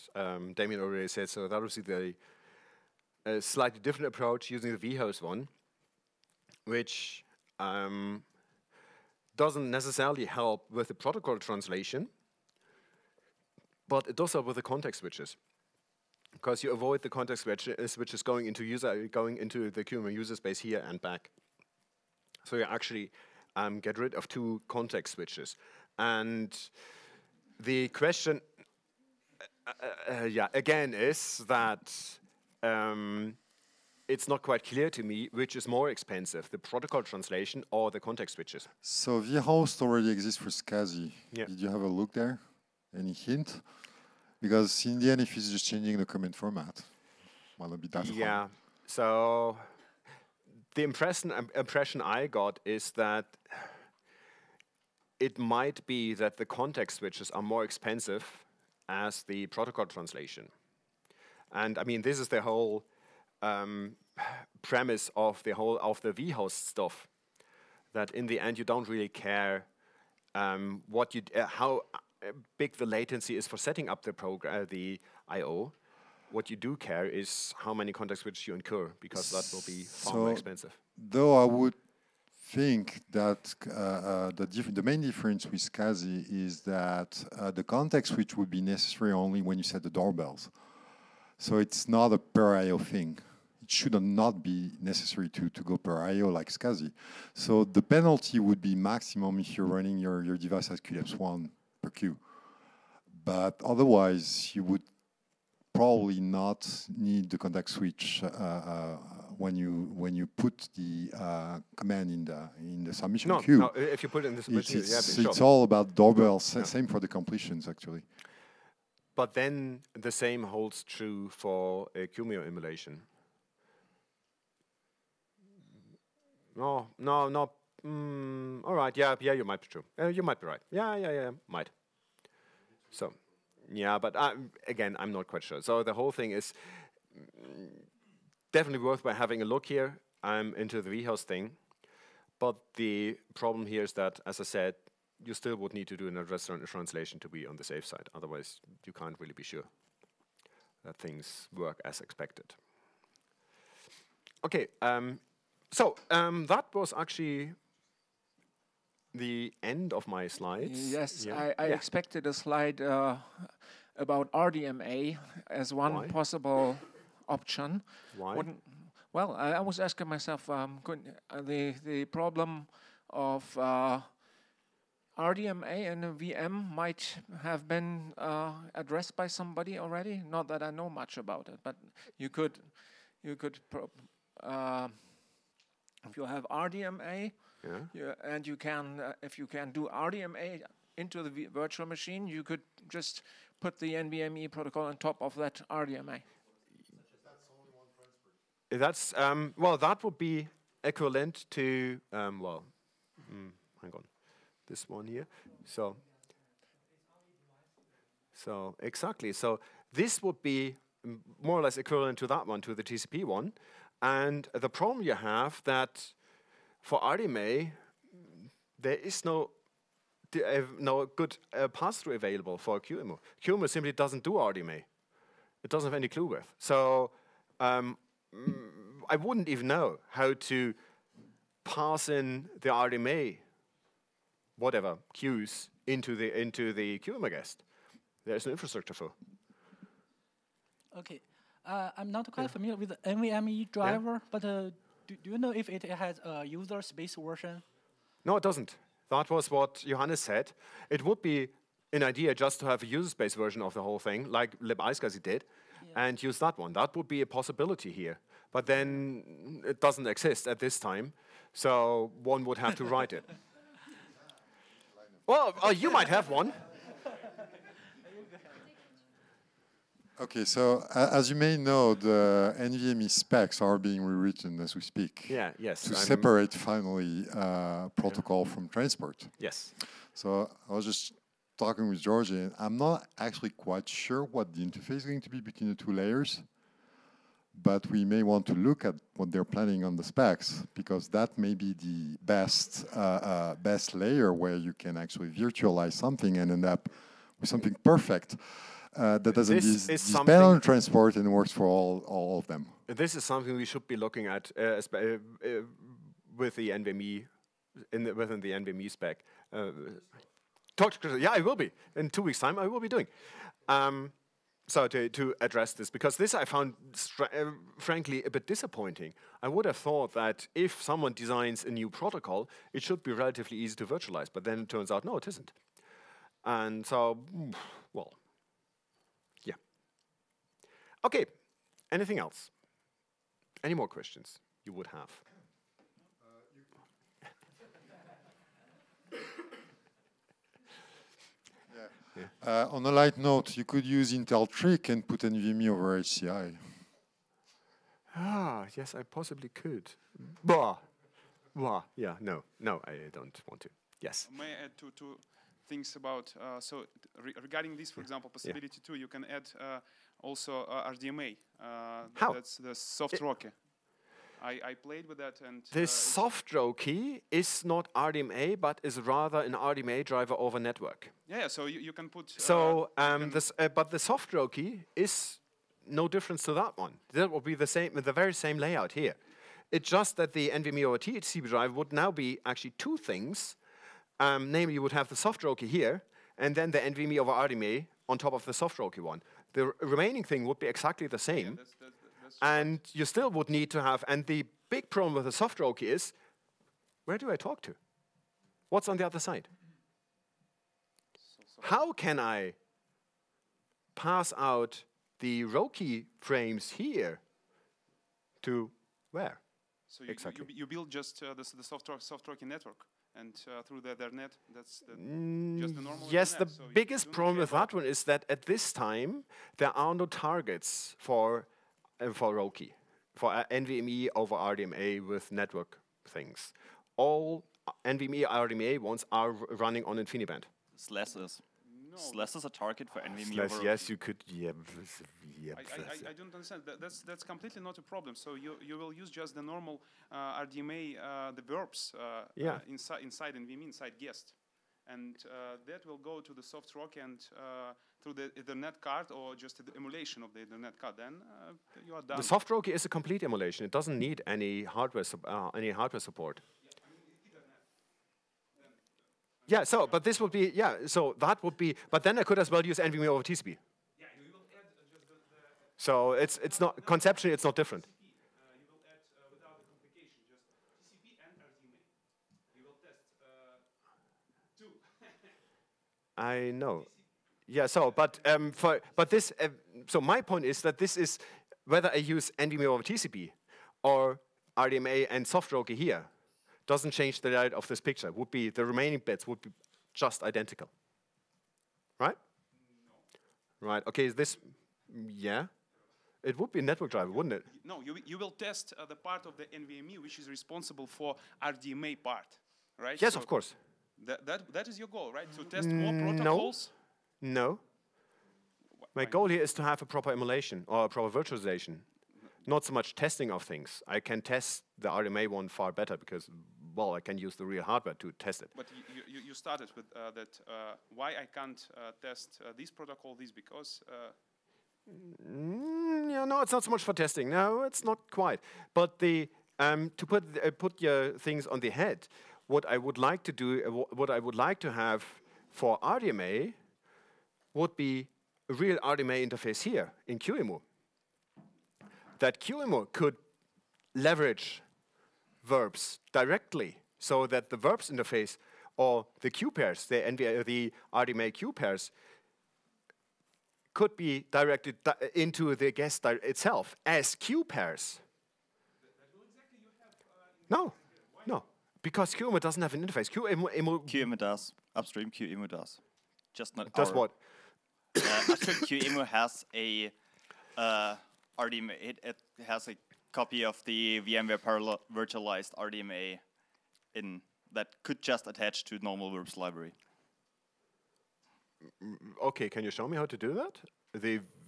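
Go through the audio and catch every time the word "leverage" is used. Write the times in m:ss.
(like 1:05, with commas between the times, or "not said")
9:03.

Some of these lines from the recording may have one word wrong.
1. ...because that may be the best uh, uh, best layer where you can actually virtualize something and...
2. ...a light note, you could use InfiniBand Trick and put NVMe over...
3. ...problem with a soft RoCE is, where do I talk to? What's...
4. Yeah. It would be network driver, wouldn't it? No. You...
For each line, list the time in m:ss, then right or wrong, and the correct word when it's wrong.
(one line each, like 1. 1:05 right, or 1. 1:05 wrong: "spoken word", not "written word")
1. 4:50 right
2. 5:42 wrong: "Intel", not "InfiniBand"
3. 6:34 right
4. 8:15 right.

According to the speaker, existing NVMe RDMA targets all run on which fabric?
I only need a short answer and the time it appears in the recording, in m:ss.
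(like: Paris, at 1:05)
InfiniBand, at 7:09.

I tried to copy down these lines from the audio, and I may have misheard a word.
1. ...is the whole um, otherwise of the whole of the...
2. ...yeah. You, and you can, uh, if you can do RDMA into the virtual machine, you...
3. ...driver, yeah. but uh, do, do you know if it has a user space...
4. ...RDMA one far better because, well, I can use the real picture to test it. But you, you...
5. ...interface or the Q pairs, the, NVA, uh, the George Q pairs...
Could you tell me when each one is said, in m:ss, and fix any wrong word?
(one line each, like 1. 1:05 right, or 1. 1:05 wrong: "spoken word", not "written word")
1. 1:02 wrong: "premise", not "otherwise"
2. 3:07 right
3. 4:03 right
4. 8:34 wrong: "hardware", not "picture"
5. 9:07 wrong: "RDMA", not "George".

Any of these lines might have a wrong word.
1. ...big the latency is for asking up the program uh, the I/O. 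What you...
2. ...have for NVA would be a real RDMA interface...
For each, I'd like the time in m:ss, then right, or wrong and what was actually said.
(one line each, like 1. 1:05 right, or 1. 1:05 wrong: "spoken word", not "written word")
1. 1:12 wrong: "setting", not "asking"
2. 8:54 wrong: "RDMA", not "NVA".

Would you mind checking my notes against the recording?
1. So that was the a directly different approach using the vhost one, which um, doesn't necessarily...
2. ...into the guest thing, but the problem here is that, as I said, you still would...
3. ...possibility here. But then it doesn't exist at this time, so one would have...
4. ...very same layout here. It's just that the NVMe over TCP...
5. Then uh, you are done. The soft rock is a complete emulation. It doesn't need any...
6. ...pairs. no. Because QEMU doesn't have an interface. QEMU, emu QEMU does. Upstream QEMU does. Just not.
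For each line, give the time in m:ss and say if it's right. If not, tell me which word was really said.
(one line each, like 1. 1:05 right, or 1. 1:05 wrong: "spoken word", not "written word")
1. 0:01 wrong: "slightly", not "directly"
2. 2:20 wrong: "vhost", not "guest"
3. 4:17 right
4. 6:18 right
5. 7:30 right
6. 9:17 right.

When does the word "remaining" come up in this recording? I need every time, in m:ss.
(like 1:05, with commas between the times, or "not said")
6:29, 8:08.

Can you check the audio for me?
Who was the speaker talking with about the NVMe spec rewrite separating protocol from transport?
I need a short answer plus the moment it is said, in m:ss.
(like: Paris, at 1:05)
George, at 4:42.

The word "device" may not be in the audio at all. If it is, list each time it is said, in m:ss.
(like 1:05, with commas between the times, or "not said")
1:40.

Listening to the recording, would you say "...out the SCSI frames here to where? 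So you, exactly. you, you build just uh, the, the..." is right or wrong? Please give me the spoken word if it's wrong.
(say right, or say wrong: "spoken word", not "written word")
wrong: "RoCE", not "SCSI".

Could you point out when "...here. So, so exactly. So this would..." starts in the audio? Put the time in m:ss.
3:25.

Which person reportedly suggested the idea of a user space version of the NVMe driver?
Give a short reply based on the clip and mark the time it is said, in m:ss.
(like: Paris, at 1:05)
Johannes, at 4:09.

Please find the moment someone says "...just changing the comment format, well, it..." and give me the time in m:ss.
0:45.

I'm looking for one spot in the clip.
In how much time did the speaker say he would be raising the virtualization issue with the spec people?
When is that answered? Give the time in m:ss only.
5:12.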